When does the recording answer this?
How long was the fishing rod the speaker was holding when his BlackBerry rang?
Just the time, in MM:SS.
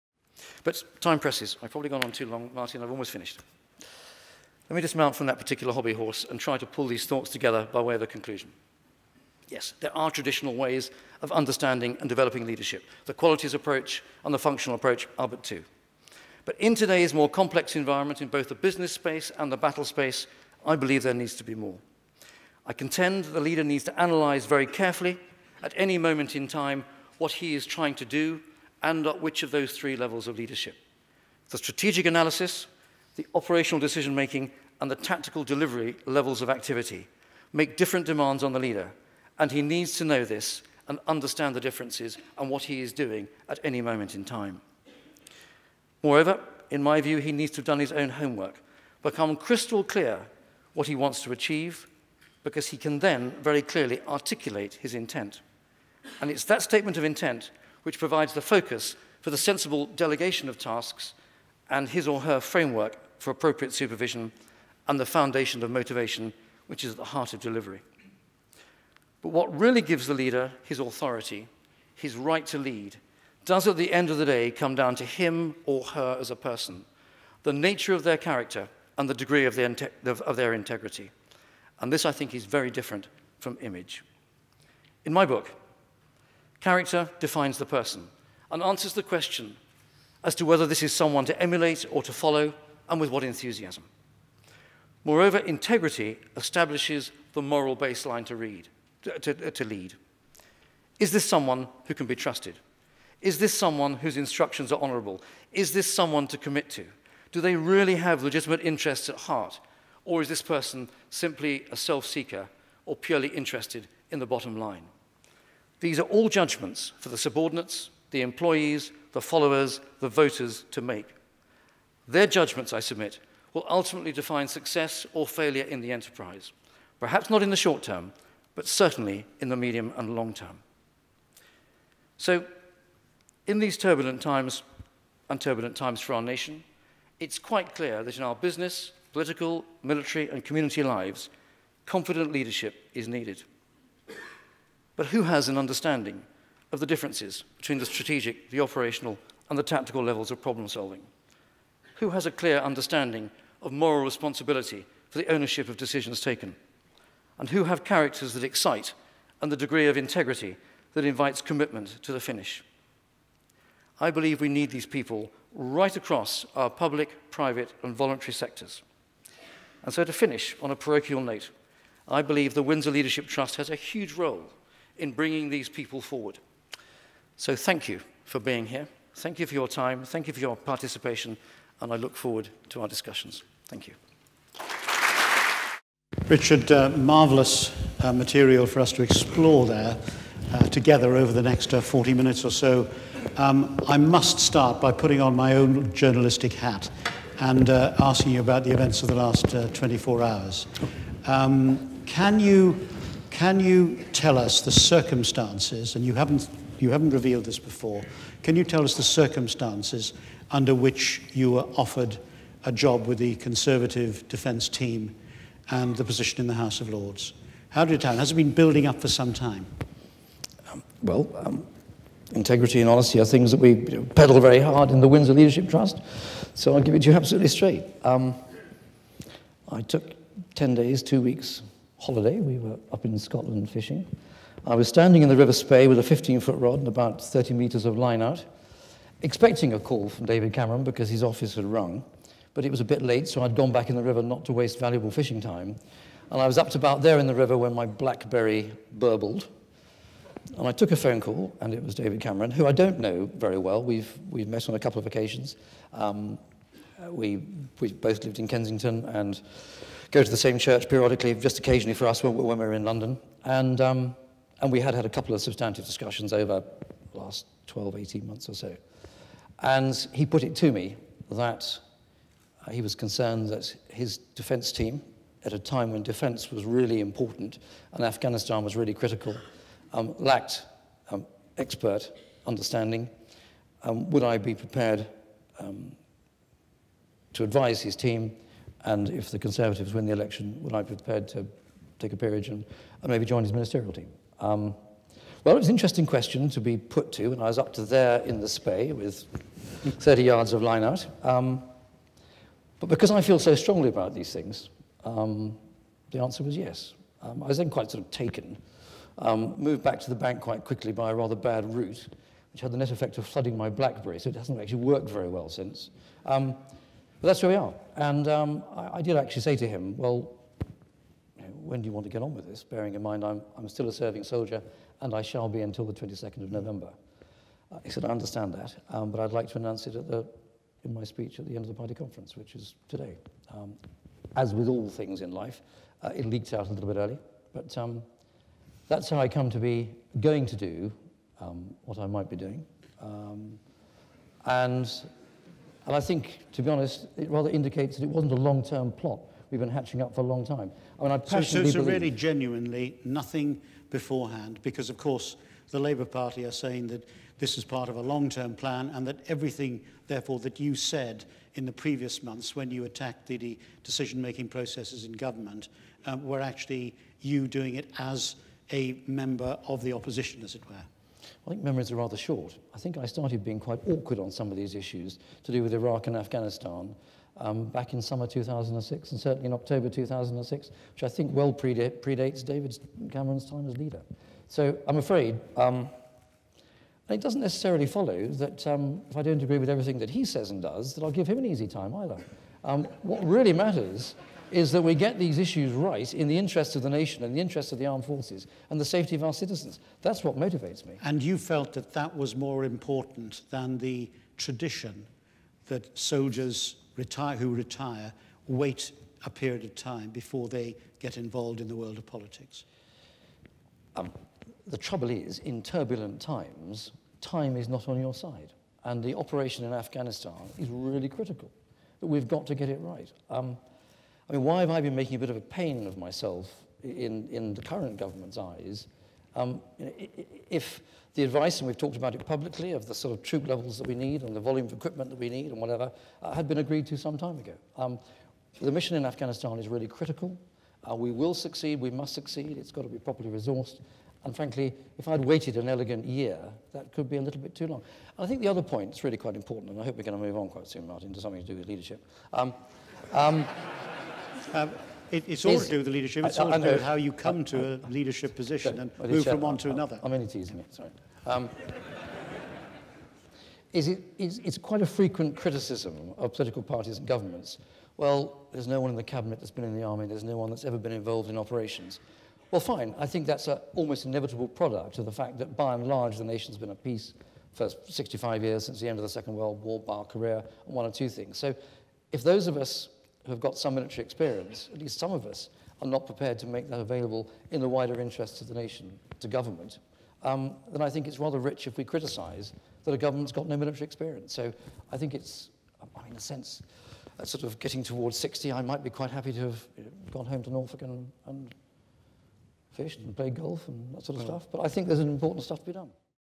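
03:56.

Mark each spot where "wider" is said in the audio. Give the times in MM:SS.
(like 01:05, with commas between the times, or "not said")
08:07.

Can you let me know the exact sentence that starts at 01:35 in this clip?
Moreover, integrity establishes the moral baseline to, read, to, to lead.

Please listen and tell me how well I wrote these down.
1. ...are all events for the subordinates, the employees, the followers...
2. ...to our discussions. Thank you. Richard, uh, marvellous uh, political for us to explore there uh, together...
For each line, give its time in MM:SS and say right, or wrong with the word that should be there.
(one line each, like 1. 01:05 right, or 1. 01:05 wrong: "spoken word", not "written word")
1. 01:55 wrong: "judgments", not "events"
2. 03:02 wrong: "material", not "political".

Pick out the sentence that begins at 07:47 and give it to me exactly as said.
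Well, there's no one in the cabinet that's been in the army.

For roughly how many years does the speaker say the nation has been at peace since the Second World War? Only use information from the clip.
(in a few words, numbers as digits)
65 years.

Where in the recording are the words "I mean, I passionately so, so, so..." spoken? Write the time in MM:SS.
05:50.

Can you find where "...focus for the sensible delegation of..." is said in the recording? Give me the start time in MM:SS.
00:58.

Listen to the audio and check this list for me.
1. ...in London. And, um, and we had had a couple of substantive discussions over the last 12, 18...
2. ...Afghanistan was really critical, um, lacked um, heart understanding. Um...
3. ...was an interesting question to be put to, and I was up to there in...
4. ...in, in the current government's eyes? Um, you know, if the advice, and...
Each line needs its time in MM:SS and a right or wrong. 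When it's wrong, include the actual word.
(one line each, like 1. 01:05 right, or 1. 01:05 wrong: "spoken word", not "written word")
1. 04:22 right
2. 04:38 wrong: "expert", not "heart"
3. 04:55 right
4. 07:06 right.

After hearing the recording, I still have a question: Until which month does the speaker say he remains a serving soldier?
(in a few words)
November.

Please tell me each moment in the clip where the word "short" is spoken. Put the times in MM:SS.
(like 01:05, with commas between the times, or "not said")
02:07, 06:12.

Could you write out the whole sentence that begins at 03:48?
Um, I took 10 days, two weeks holiday.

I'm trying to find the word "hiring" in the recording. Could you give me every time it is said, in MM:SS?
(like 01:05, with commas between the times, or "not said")
not said.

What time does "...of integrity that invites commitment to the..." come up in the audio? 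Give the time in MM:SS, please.
02:39.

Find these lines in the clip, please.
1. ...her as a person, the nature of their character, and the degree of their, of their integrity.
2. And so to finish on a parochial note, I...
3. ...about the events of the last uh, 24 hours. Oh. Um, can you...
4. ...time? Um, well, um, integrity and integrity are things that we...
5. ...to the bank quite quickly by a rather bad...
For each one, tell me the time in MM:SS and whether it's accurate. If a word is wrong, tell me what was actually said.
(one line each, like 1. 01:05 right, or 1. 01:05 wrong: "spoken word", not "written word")
1. 01:15 right
2. 02:49 right
3. 03:18 right
4. 03:39 wrong: "honesty", not "integrity"
5. 05:10 right.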